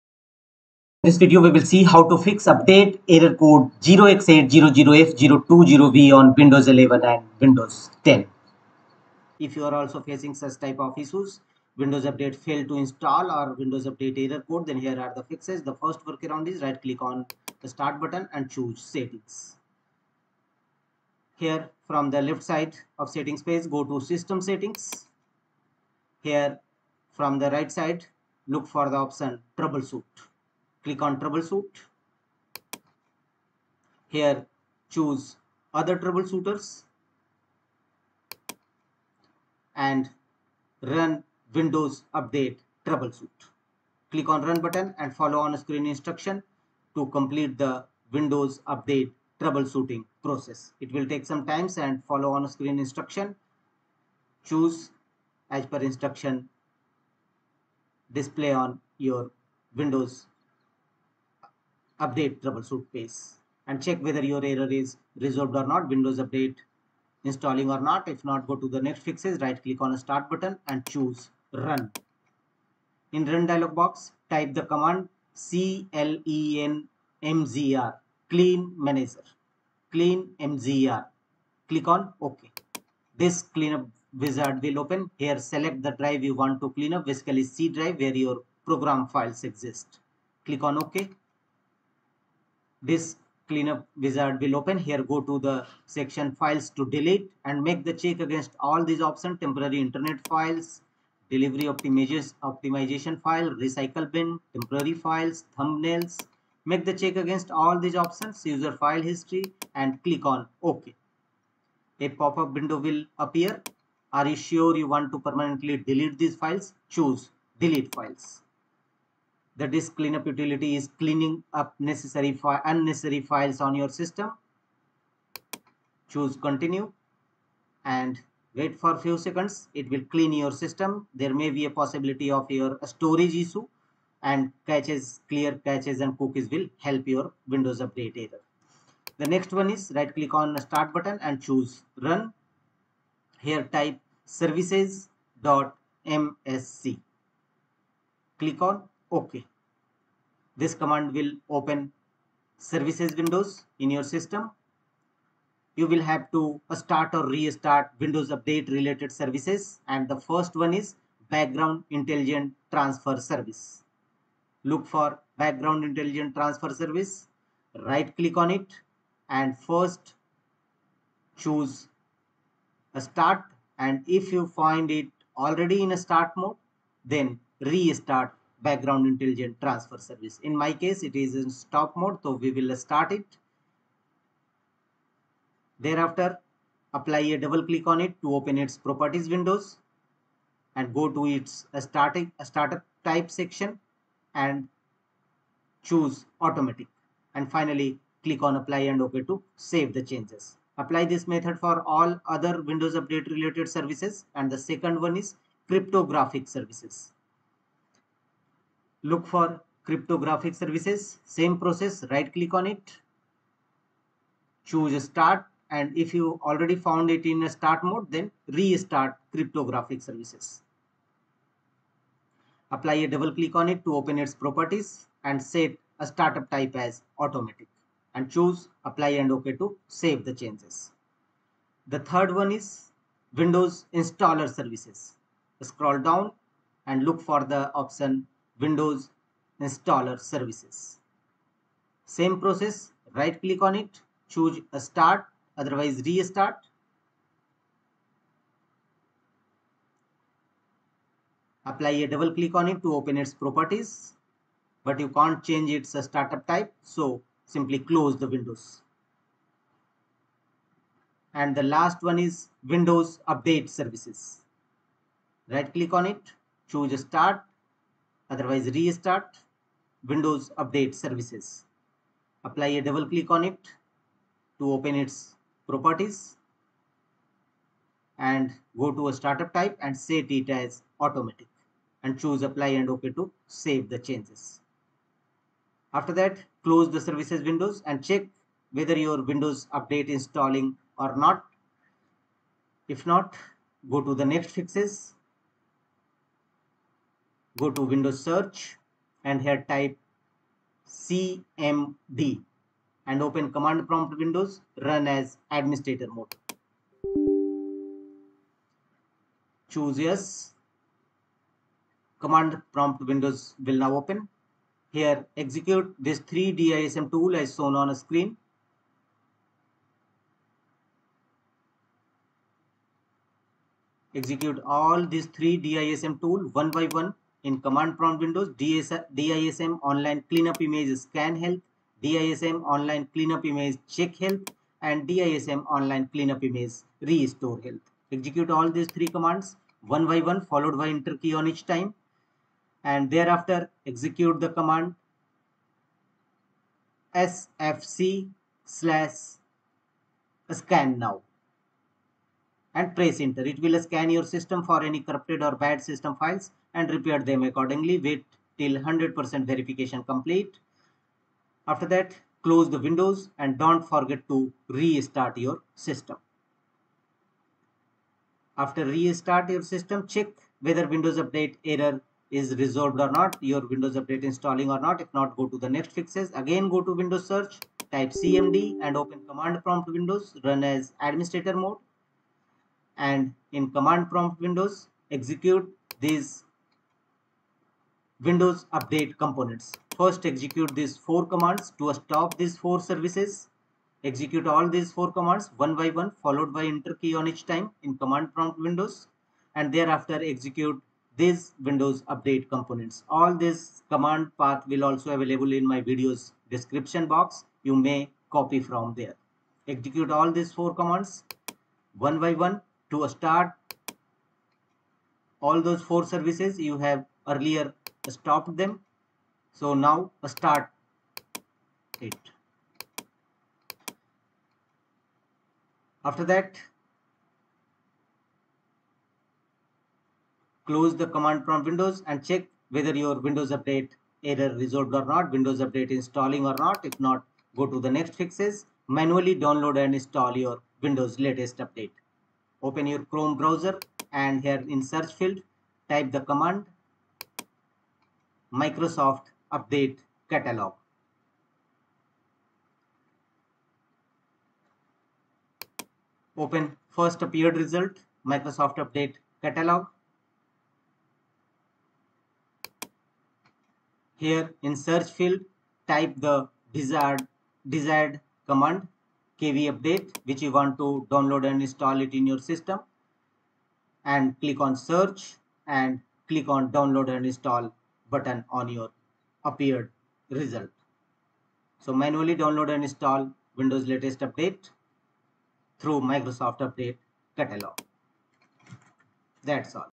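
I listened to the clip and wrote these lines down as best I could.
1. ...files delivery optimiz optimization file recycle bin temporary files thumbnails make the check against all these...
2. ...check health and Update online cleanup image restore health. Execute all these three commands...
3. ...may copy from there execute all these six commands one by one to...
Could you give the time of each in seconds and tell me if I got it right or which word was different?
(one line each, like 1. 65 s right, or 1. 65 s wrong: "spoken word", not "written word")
1. 100 s right
2. 333 s wrong: "DISM", not "Update"
3. 407 s wrong: "four", not "six".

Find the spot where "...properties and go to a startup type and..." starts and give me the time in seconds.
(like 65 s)
275 s.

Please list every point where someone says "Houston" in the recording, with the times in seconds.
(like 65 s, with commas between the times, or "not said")
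not said.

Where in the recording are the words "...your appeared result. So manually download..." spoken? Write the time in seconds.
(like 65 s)
478 s.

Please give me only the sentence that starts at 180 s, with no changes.
In my case, it is in stop mode, so we will start it.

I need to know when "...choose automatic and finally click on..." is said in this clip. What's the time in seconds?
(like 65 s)
195 s.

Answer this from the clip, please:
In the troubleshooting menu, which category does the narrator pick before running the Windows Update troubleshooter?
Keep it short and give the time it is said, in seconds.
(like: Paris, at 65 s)
Other troubleshooters, at 35 s.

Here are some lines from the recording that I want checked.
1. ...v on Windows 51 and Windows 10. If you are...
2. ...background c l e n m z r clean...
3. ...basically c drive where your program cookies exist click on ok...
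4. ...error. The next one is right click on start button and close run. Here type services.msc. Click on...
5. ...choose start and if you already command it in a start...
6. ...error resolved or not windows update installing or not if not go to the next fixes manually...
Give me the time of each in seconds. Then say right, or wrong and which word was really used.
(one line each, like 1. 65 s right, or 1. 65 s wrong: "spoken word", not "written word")
1. 5 s wrong: "11", not "51"
2. 74 s wrong: "command", not "background"
3. 87 s wrong: "files", not "cookies"
4. 138 s wrong: "choose", not "close"
5. 214 s wrong: "found", not "command"
6. 434 s right.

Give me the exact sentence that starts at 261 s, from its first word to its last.
And the last one is Windows Update Services.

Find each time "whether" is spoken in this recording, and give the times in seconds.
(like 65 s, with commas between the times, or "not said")
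64 s, 288 s, 370 s, 432 s.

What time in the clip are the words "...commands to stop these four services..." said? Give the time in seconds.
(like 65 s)
391 s.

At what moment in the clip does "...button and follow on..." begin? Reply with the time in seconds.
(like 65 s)
44 s.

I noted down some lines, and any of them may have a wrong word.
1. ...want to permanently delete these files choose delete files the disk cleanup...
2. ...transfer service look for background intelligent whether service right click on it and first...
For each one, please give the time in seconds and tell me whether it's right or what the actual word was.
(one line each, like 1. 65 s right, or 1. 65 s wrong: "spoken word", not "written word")
1. 114 s right
2. 162 s wrong: "transfer", not "whether".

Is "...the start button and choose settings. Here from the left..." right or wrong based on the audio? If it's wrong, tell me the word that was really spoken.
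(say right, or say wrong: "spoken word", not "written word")
right.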